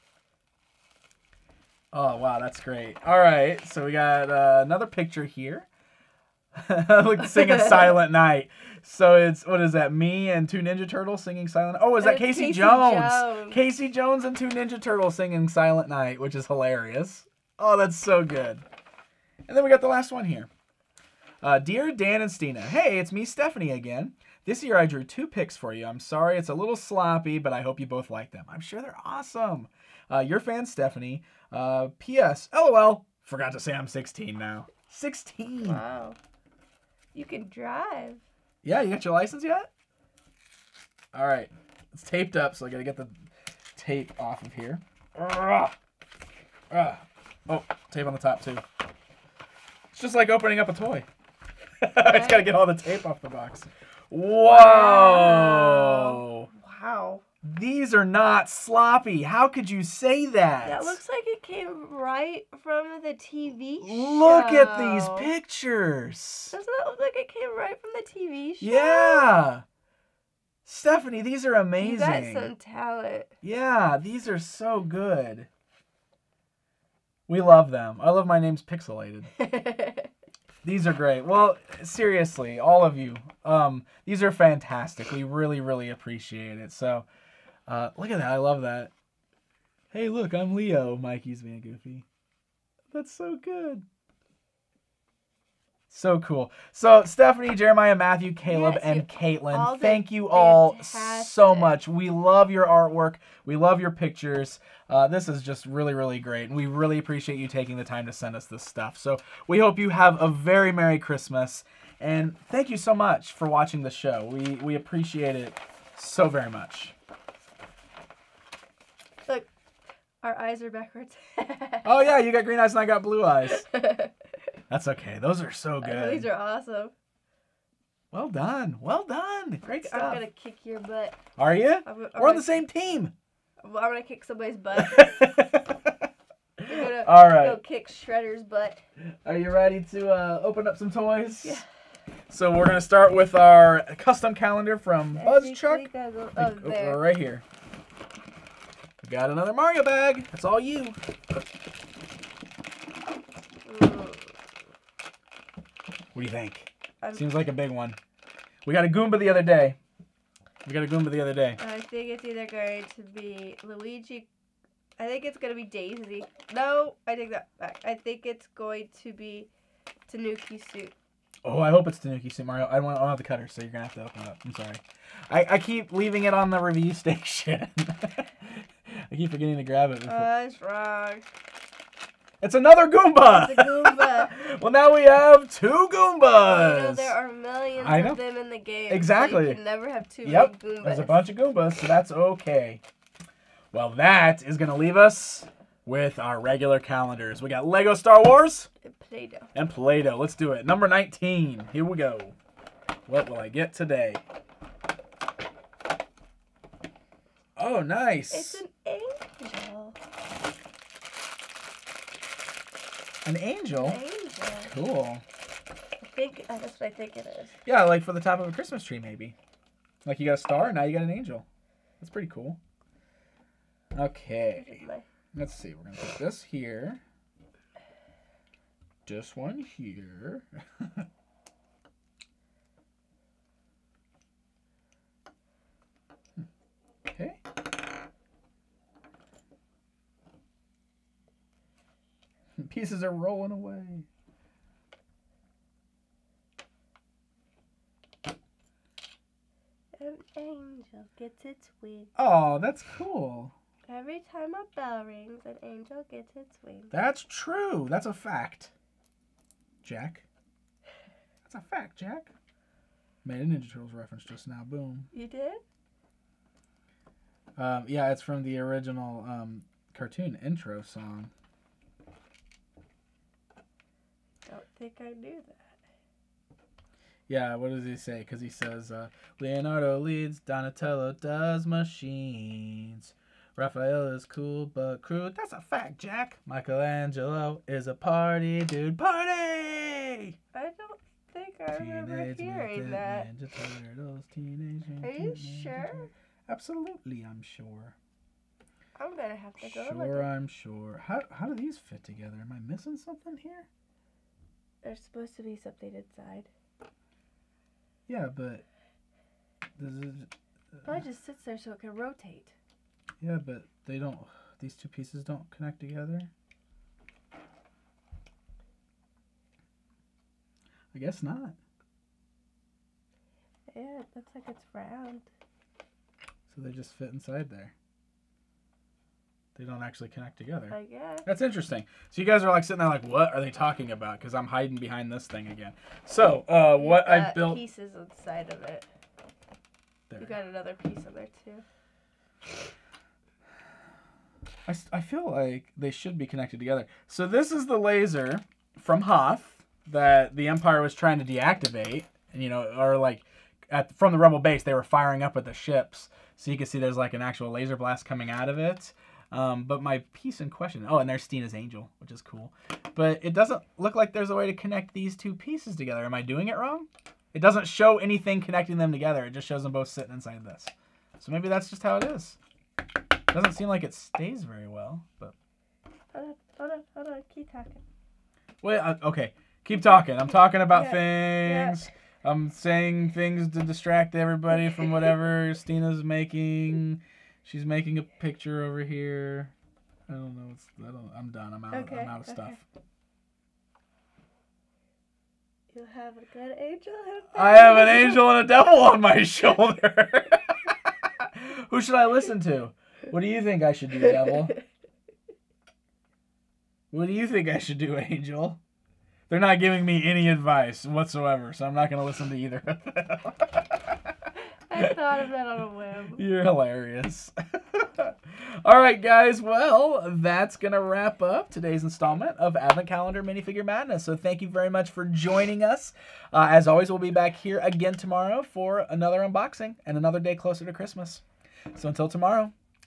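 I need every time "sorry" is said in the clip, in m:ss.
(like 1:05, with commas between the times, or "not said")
0:25, 2:54.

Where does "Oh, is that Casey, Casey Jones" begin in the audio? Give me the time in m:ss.
0:11.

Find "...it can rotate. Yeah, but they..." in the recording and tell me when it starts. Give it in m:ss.
5:11.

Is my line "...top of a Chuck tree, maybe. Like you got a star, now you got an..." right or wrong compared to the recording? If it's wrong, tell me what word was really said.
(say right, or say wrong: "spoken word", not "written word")
wrong: "Christmas", not "Chuck".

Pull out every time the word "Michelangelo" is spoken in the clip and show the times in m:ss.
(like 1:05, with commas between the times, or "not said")
4:46.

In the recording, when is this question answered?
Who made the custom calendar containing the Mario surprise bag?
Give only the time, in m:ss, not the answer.
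2:25.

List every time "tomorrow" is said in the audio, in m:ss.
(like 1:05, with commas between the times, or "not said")
7:07, 7:12.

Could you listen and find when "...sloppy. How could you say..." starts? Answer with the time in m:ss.
0:58.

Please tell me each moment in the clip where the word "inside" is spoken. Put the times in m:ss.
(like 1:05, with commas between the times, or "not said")
5:05, 5:27, 5:37, 6:10.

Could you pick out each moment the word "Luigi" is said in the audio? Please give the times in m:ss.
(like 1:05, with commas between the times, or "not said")
2:43.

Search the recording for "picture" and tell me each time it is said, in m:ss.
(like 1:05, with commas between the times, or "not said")
0:04, 1:05, 1:43, 6:28.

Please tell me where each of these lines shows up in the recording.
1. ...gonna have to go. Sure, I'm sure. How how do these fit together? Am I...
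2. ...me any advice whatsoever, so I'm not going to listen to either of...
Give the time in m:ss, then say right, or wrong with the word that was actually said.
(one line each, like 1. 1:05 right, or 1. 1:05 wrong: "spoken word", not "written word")
1. 4:59 right
2. 6:49 right.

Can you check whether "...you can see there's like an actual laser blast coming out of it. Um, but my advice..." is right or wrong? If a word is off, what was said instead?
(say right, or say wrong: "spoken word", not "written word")
wrong: "piece", not "advice".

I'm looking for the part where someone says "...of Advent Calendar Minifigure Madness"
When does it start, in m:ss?
7:02.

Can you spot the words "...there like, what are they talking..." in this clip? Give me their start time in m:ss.
5:32.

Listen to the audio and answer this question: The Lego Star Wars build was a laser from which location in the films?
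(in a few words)
Hoth.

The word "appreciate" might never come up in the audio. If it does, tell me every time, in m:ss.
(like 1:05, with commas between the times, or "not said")
1:25, 1:46, 1:54.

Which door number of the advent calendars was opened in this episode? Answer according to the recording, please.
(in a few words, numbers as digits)
19.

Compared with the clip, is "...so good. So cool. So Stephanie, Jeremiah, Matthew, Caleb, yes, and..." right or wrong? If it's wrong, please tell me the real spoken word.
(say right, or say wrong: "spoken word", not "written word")
right.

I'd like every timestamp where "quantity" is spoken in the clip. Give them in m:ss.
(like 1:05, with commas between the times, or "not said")
not said.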